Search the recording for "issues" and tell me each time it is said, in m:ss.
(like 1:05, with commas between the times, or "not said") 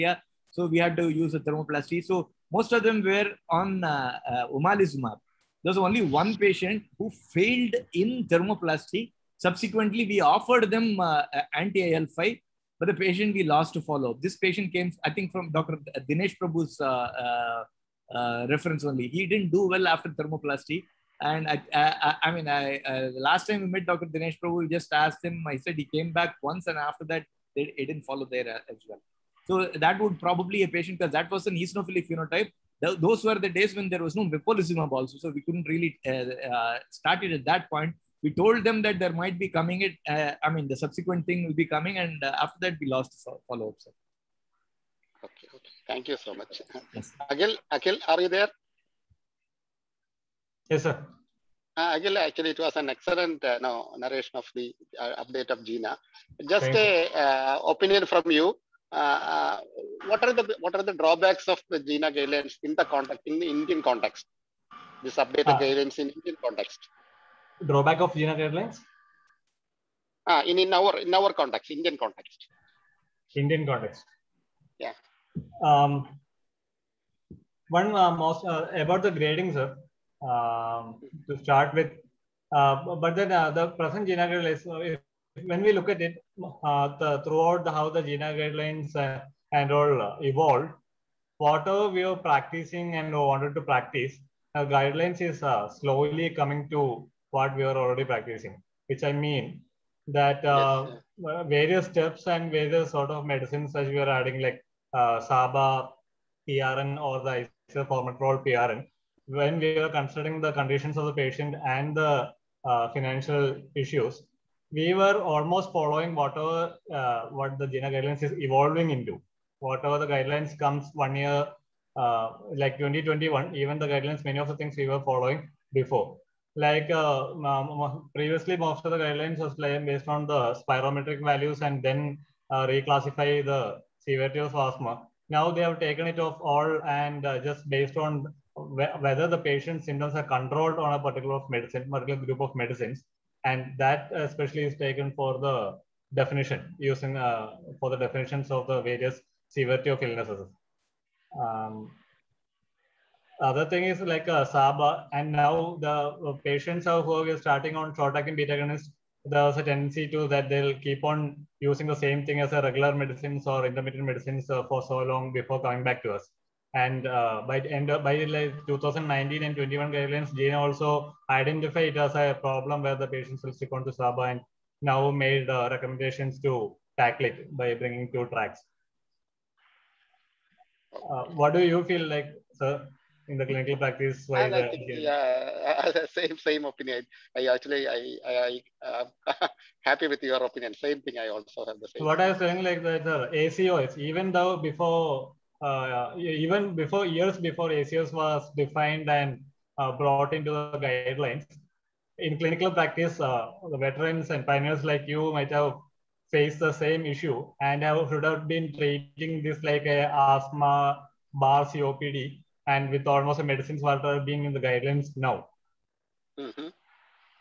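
1:53, 3:27.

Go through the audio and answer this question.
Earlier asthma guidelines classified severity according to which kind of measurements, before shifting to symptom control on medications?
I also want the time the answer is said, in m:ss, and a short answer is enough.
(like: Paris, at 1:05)
Spirometric values, at 2:10.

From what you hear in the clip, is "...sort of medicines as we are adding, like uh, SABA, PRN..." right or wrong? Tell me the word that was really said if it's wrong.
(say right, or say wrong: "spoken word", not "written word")
right.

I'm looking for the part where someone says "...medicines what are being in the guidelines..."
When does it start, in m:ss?
3:33.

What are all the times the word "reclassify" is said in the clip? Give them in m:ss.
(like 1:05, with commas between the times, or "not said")
2:12.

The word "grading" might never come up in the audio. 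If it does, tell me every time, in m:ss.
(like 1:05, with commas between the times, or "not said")
1:19.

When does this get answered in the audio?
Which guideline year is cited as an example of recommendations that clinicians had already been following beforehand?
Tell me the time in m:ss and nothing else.
2:02.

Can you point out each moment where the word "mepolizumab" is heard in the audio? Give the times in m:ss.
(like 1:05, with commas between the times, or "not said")
0:34.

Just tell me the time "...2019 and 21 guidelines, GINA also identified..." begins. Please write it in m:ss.
2:48.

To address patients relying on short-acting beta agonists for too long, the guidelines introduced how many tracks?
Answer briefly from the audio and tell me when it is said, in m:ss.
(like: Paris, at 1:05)
2, at 2:58.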